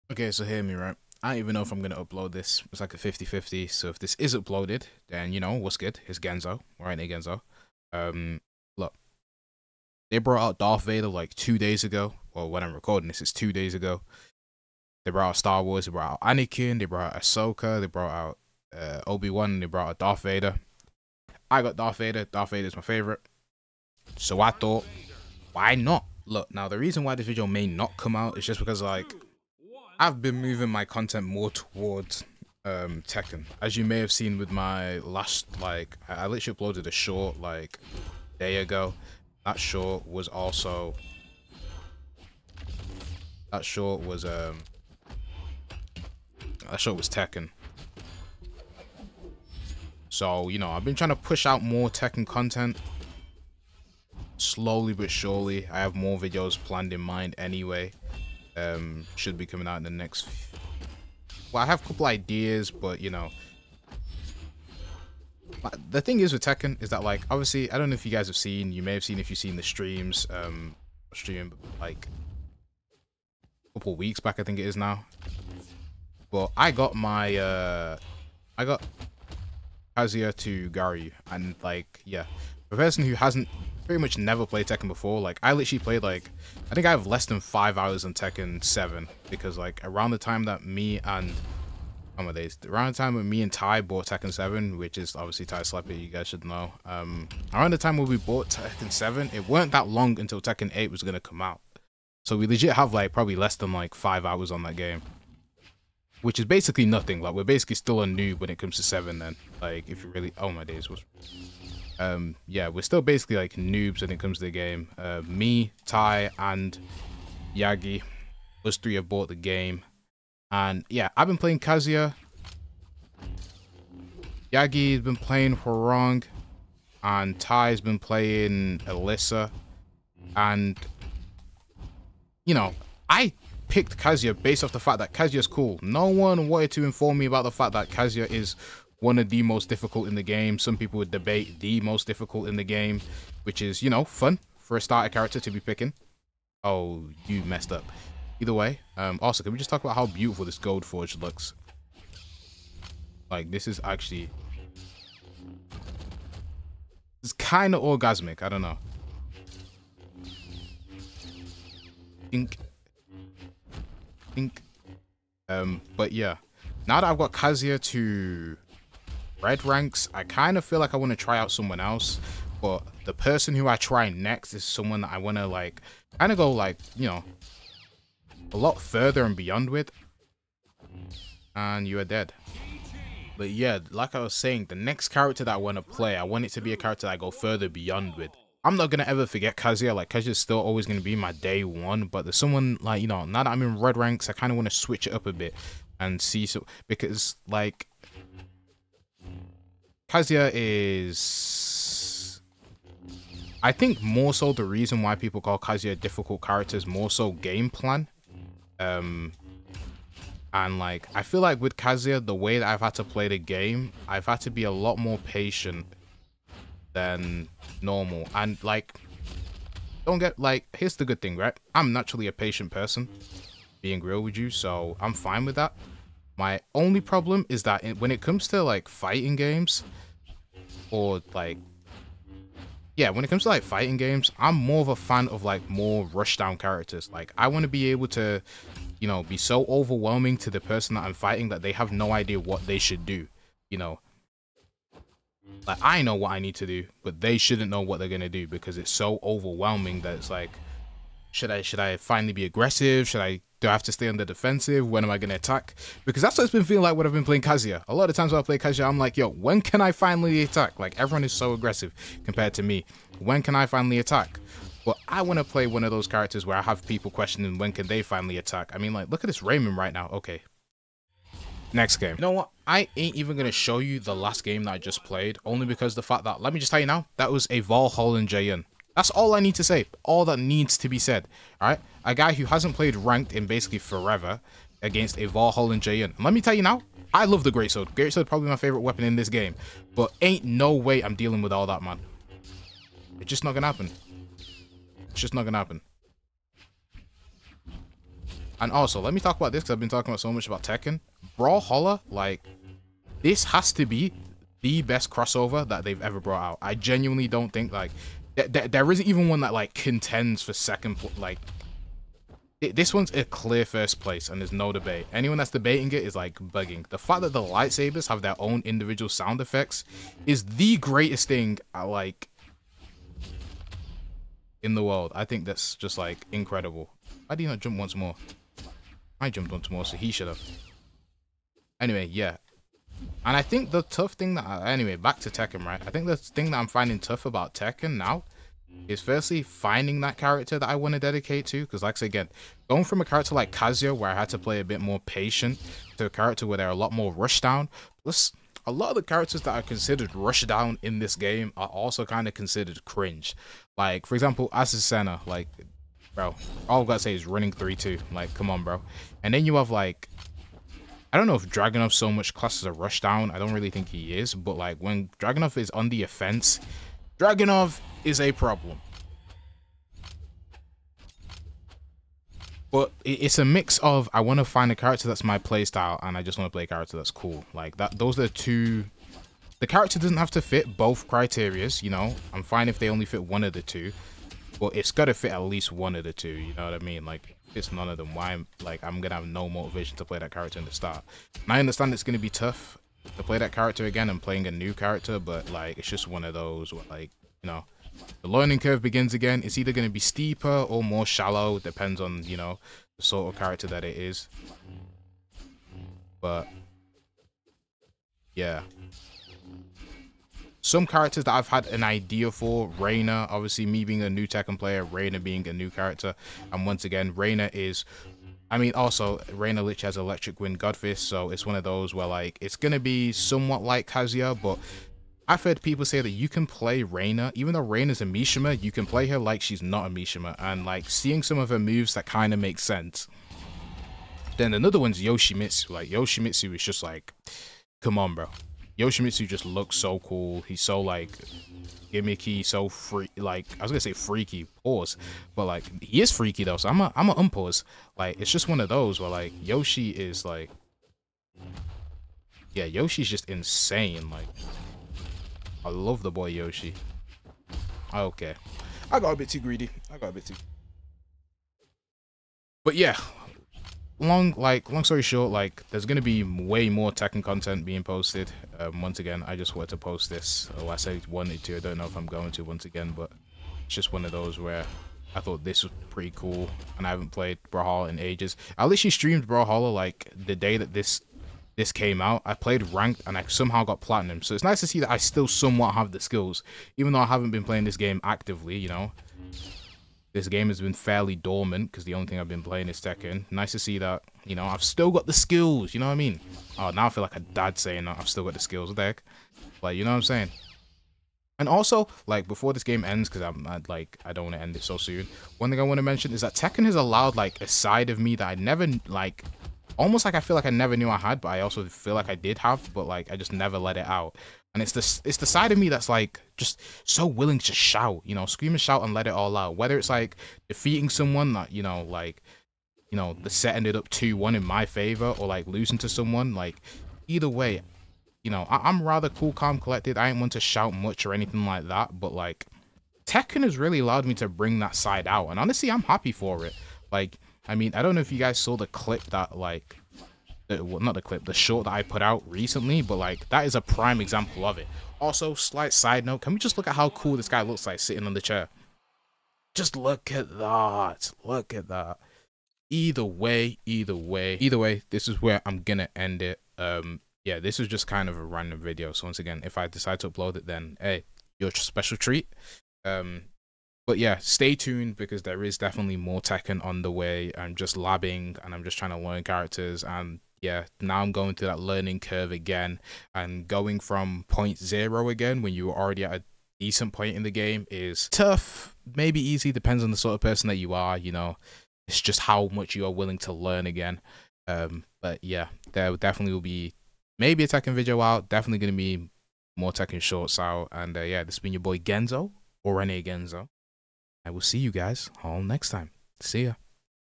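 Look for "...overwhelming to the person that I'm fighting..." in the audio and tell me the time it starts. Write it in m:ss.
3:59.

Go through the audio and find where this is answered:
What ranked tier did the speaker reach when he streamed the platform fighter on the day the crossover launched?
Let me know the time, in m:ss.
8:03.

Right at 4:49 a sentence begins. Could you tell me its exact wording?
But ain't no way I'm dealing with all that, man.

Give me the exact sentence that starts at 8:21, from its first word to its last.
And also, like, before this game ends, because I'm I'd, like, I don't want to end it so soon.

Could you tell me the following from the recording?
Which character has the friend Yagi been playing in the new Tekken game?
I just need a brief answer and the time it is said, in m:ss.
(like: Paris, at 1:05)
Hwoarang, at 2:05.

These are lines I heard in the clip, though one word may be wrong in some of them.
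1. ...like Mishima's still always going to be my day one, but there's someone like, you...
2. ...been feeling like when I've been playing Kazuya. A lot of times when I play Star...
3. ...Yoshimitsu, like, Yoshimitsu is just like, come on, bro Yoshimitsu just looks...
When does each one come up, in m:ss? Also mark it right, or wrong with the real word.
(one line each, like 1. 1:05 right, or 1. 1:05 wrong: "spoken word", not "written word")
1. 3:09 wrong: "Kazuya", not "Mishima"
2. 4:16 wrong: "Kazuya", not "Star"
3. 7:15 right.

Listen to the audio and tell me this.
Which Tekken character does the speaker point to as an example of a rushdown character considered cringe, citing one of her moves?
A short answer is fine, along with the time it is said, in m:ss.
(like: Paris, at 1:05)
Azucena, at 5:54.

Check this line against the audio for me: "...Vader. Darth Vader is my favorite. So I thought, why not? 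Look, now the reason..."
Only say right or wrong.
right.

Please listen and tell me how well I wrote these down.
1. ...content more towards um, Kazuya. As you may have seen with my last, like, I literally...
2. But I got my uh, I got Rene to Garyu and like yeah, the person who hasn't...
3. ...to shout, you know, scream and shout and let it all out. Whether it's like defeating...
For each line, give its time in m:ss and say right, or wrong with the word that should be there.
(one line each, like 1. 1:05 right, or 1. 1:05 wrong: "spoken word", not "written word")
1. 0:30 wrong: "Tekken", not "Kazuya"
2. 1:16 wrong: "Kazuya", not "Rene"
3. 8:37 right.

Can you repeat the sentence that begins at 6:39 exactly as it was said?
It's either gonna be steeper or more shallow.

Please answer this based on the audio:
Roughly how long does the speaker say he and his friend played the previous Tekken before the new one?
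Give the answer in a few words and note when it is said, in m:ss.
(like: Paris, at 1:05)
less than 5 hours, at 1:27.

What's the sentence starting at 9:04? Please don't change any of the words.
Also, slight side note, can we just look at how cool this guy looks like sitting on the chair?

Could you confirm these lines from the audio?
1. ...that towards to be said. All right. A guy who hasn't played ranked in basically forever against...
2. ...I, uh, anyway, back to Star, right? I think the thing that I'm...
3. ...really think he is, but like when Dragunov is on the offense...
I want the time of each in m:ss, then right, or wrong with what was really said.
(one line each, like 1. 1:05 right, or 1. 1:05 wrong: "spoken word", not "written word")
1. 4:40 wrong: "needs", not "towards"
2. 5:34 wrong: "Tekken", not "Star"
3. 6:03 right.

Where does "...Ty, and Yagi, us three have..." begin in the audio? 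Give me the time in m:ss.
1:55.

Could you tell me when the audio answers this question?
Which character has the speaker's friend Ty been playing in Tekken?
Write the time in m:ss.
2:08.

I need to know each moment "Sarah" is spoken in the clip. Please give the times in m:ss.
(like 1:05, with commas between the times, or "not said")
not said.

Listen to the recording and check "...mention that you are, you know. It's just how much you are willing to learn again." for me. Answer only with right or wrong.
wrong.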